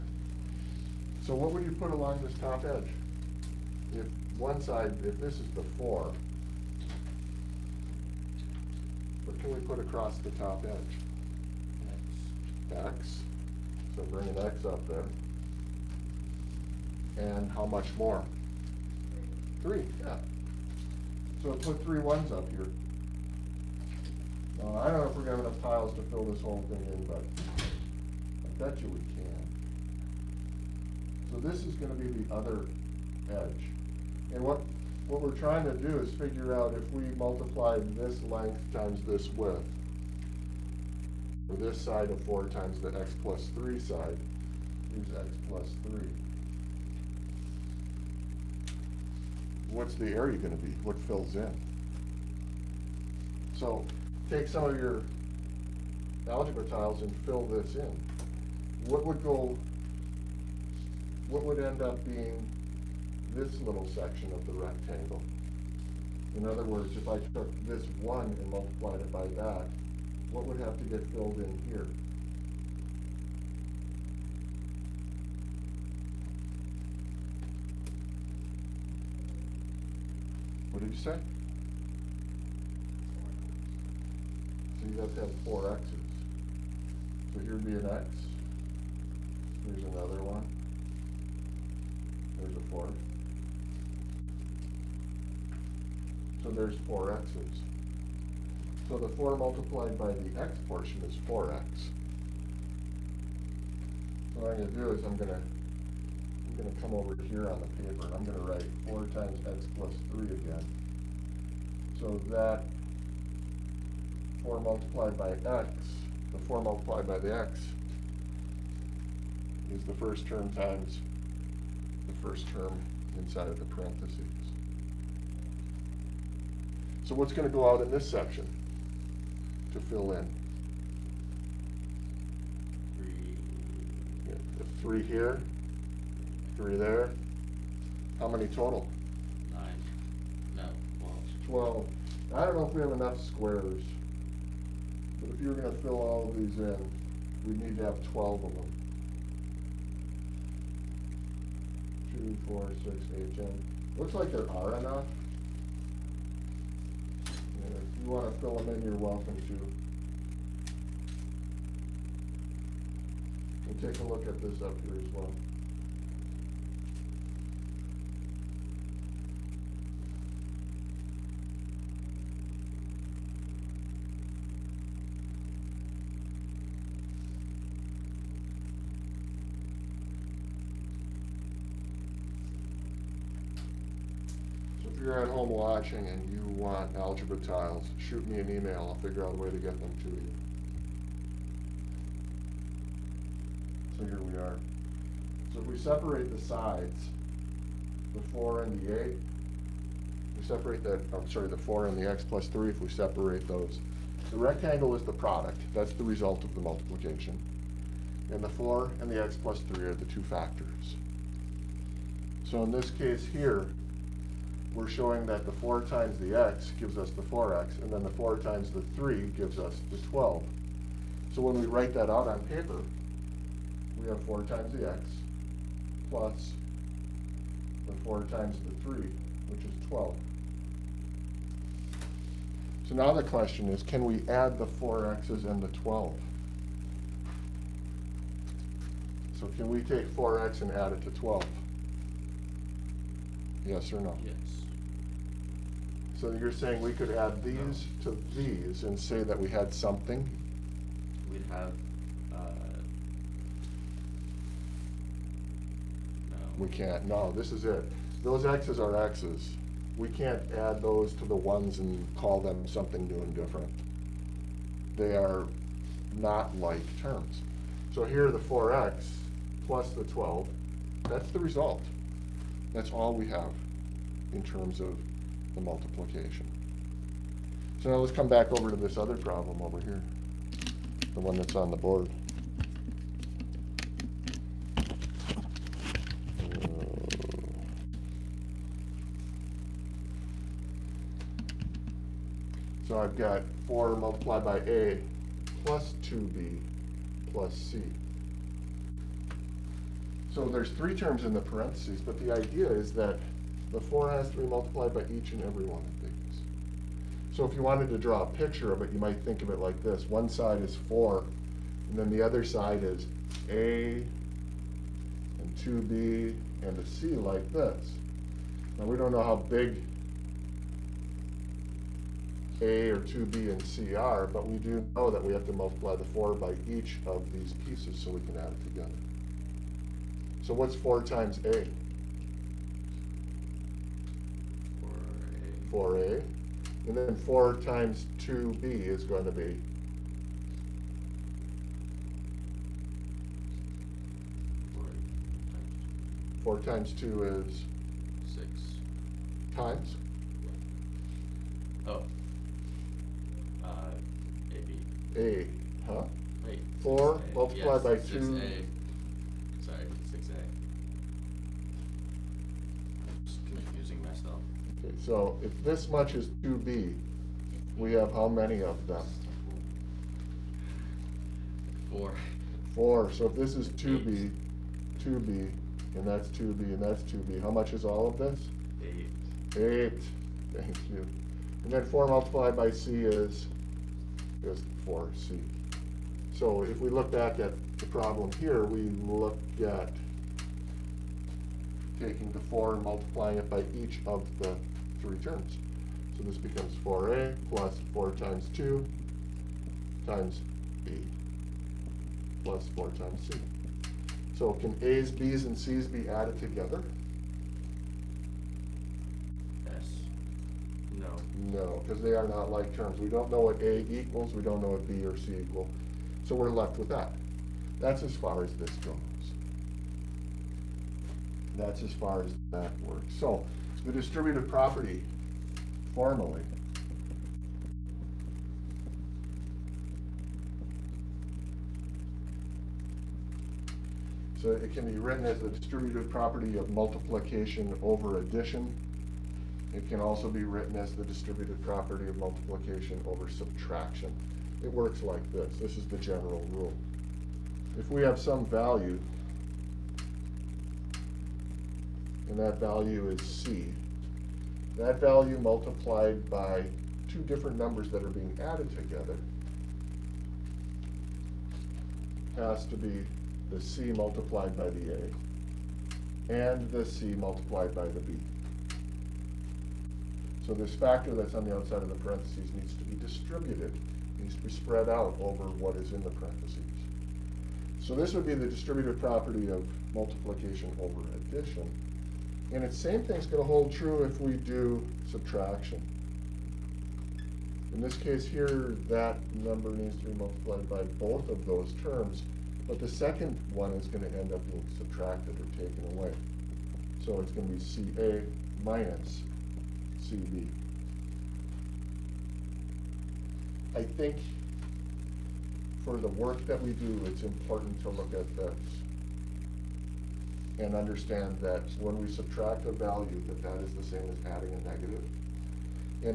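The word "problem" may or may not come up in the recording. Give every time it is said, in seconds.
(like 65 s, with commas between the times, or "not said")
279 s, 387 s.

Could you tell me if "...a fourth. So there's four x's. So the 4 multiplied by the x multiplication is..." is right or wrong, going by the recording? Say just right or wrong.
wrong.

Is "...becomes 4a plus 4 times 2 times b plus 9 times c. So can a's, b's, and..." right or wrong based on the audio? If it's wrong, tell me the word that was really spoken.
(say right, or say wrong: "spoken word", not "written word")
wrong: "4", not "9".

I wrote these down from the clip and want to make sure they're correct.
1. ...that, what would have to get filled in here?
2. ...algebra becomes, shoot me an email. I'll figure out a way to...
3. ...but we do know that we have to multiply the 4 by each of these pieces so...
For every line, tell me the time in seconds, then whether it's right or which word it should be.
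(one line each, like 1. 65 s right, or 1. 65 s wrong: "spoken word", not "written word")
1. 69 s right
2. 186 s wrong: "tiles", not "becomes"
3. 324 s right.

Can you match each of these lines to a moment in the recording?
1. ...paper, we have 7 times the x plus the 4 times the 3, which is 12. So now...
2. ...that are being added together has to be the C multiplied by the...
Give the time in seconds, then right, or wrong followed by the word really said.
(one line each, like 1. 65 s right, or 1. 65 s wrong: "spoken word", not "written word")
1. 222 s wrong: "4", not "7"
2. 457 s right.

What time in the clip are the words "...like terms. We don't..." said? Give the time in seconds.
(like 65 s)
412 s.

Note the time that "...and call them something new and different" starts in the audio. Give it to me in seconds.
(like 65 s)
261 s.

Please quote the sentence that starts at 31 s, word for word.
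So this is going to be the other edge.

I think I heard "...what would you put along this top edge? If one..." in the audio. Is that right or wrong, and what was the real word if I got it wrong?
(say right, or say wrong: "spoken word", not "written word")
right.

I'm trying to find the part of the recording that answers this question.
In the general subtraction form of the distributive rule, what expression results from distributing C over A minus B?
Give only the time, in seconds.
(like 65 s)
497 s.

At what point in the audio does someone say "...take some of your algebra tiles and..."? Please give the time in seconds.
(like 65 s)
54 s.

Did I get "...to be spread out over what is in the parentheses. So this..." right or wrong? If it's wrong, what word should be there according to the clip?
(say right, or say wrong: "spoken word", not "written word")
right.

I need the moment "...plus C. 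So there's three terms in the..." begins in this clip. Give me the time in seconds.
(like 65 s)
297 s.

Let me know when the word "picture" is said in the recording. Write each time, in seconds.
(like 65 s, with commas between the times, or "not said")
308 s.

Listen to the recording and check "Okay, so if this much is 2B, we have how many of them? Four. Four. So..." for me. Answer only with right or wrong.
right.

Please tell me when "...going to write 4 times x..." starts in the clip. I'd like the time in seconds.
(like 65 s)
108 s.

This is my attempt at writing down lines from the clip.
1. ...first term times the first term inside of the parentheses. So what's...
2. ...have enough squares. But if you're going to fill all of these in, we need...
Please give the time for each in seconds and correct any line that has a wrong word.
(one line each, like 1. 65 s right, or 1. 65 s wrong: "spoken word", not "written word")
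1. 119 s right
2. 142 s right.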